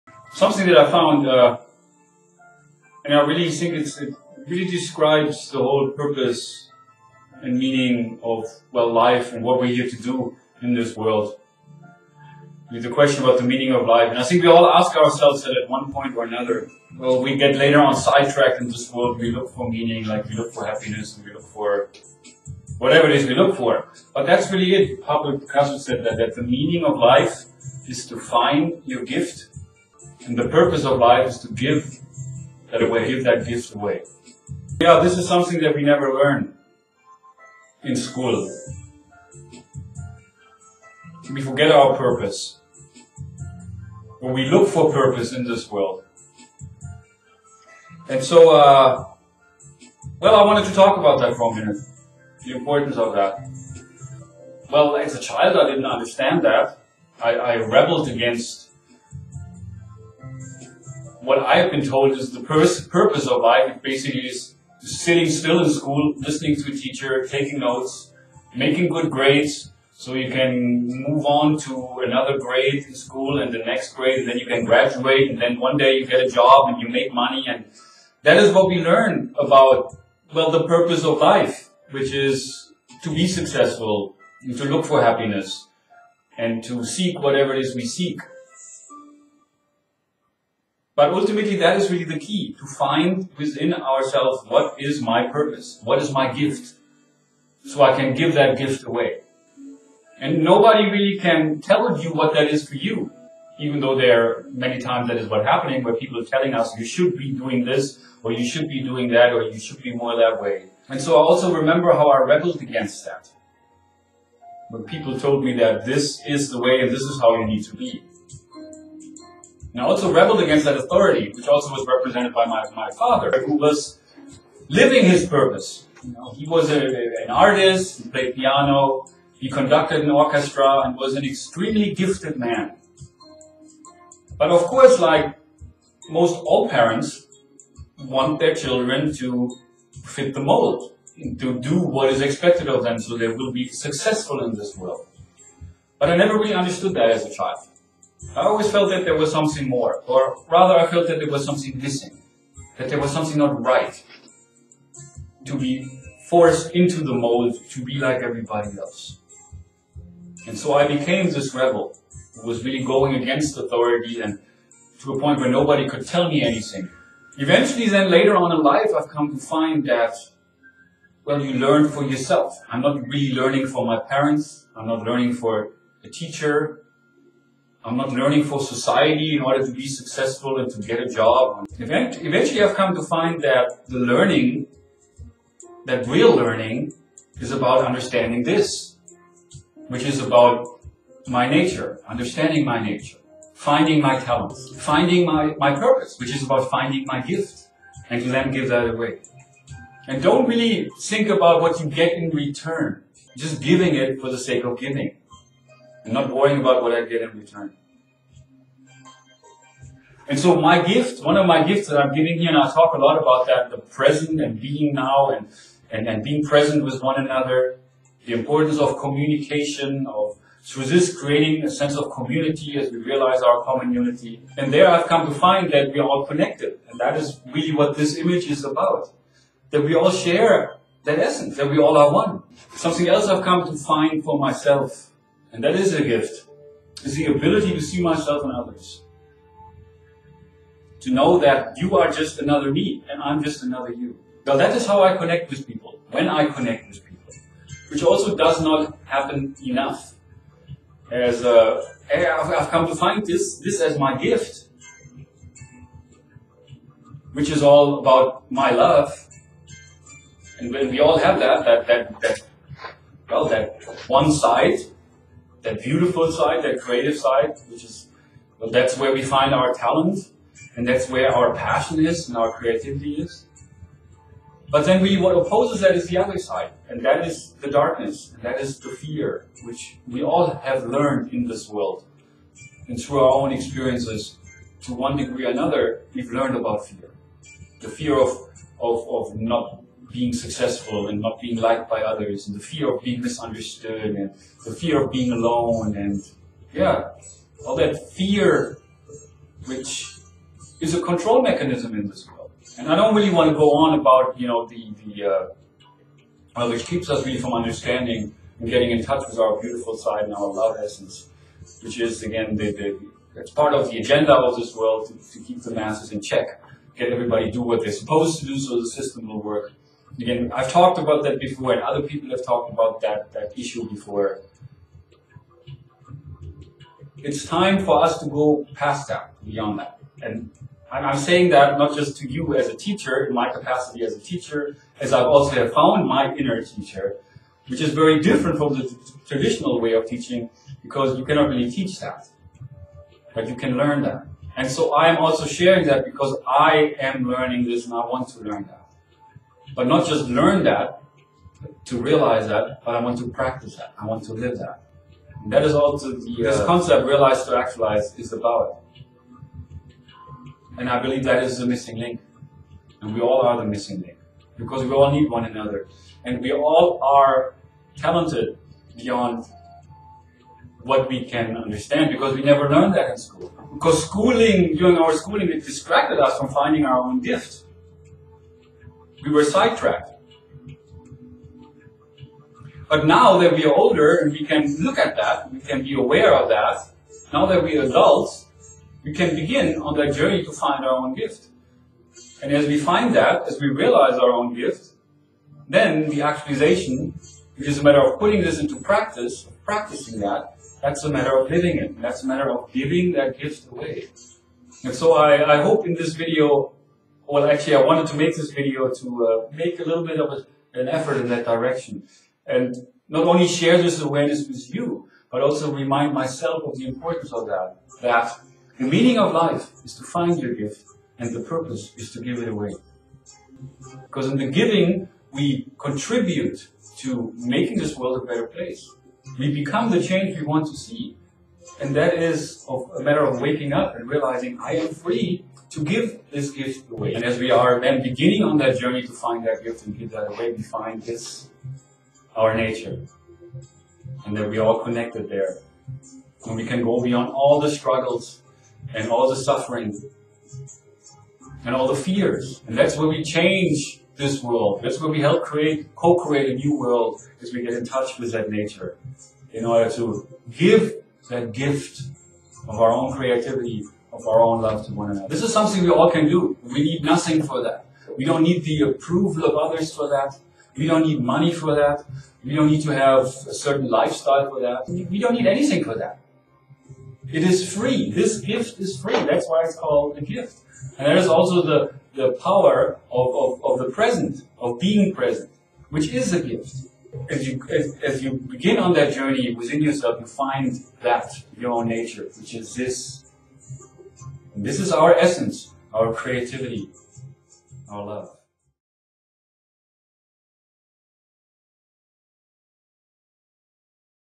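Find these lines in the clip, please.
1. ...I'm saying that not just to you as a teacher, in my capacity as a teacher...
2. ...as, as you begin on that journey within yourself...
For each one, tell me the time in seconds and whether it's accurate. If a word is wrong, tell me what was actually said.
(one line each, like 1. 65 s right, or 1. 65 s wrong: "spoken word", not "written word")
1. 330 s right
2. 487 s right.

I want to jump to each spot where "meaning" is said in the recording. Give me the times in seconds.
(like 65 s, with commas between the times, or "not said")
7 s, 13 s, 19 s, 26 s, 418 s.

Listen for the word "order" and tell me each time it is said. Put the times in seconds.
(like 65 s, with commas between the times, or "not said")
179 s, 459 s.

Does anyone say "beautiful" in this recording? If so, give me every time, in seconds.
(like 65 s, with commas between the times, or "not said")
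265 s, 309 s.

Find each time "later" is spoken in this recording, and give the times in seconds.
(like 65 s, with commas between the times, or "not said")
17 s, 168 s.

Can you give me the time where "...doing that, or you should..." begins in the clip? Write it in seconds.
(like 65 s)
108 s.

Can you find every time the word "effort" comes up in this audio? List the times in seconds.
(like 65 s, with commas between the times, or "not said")
410 s.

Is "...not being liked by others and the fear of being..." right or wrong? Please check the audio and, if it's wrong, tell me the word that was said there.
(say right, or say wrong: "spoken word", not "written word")
right.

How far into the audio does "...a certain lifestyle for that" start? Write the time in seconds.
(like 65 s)
473 s.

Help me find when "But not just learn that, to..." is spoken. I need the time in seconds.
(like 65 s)
349 s.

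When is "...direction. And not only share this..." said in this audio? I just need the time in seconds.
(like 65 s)
411 s.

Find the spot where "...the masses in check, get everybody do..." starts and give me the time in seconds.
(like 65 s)
315 s.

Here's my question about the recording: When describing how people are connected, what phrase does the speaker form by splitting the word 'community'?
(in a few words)
common unity.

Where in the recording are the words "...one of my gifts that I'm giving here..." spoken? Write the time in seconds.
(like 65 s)
211 s.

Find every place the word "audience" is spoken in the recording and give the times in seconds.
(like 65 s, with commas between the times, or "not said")
not said.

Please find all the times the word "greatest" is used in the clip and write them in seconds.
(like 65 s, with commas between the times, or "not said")
not said.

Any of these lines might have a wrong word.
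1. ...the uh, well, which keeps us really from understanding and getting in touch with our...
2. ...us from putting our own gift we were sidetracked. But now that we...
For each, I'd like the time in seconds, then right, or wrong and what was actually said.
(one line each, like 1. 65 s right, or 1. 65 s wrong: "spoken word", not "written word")
1. 305 s right
2. 376 s wrong: "finding", not "putting".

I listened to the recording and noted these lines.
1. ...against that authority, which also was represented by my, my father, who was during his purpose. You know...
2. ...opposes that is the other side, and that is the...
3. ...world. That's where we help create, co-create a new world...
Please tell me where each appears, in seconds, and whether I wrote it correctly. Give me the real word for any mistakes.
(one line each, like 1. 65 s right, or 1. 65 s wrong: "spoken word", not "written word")
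1. 120 s wrong: "living", not "during"
2. 275 s right
3. 454 s right.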